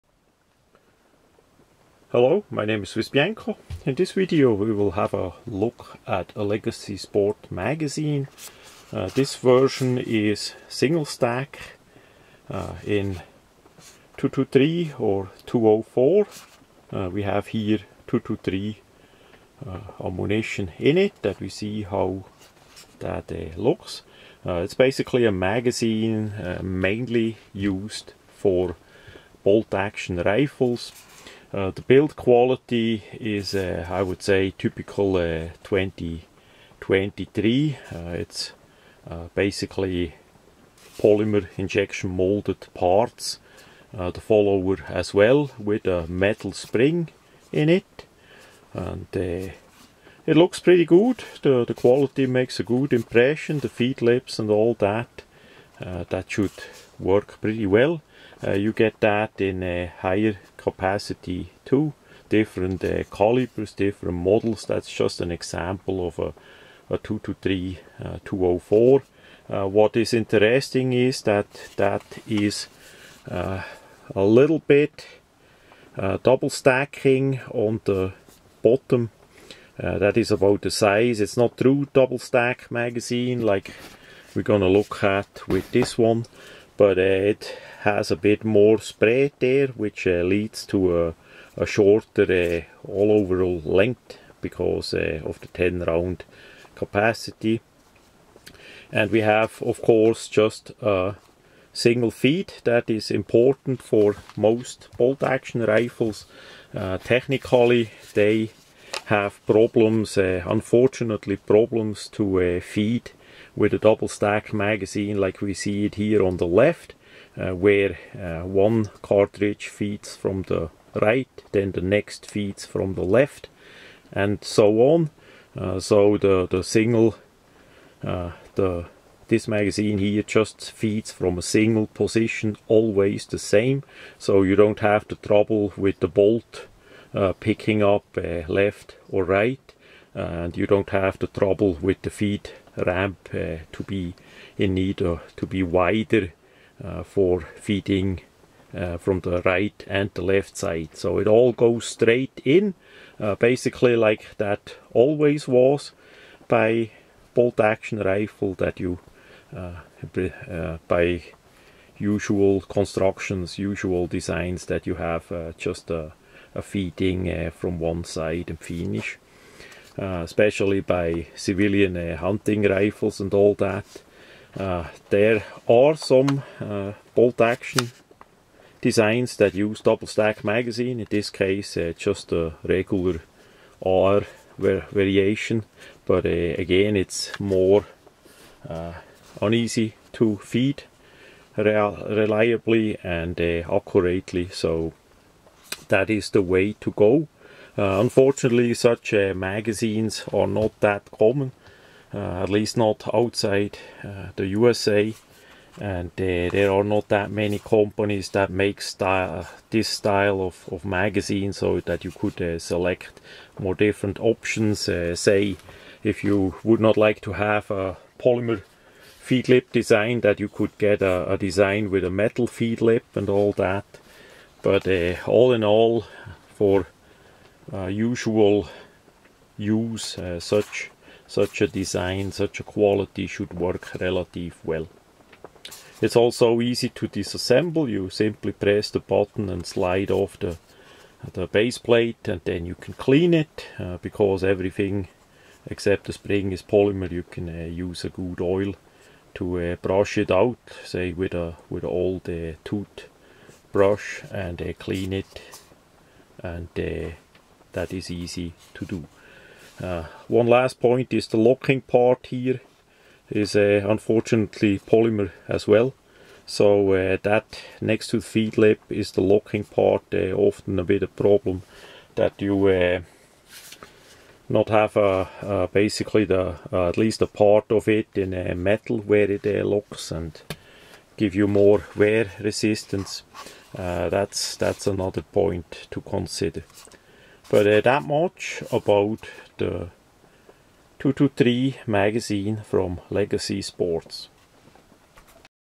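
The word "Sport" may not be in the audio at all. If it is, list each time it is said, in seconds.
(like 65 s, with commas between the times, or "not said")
6 s, 293 s.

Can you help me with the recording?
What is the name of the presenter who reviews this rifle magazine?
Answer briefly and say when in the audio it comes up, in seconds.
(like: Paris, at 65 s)
Bianco, at 3 s.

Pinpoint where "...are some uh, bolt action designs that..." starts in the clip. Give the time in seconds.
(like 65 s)
175 s.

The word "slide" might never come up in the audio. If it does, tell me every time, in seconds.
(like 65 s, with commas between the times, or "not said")
239 s.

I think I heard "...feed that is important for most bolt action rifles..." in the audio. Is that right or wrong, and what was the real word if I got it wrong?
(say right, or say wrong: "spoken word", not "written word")
right.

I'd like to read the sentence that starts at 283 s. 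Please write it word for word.
that's that's another point to consider.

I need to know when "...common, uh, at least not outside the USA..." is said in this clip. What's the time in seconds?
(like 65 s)
201 s.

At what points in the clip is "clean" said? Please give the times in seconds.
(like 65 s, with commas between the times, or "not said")
242 s, 254 s.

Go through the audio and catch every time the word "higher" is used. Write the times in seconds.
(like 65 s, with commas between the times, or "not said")
59 s.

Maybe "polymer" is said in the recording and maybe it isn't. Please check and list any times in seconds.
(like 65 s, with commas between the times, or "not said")
40 s, 218 s, 246 s, 264 s.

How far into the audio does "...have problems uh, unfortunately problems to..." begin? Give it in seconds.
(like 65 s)
109 s.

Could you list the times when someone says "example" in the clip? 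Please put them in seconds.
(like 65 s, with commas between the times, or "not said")
65 s.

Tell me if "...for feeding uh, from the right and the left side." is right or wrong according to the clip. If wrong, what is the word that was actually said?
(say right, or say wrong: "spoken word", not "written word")
right.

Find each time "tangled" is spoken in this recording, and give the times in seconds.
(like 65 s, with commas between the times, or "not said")
not said.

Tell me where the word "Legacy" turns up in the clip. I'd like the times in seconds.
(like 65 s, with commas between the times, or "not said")
6 s, 293 s.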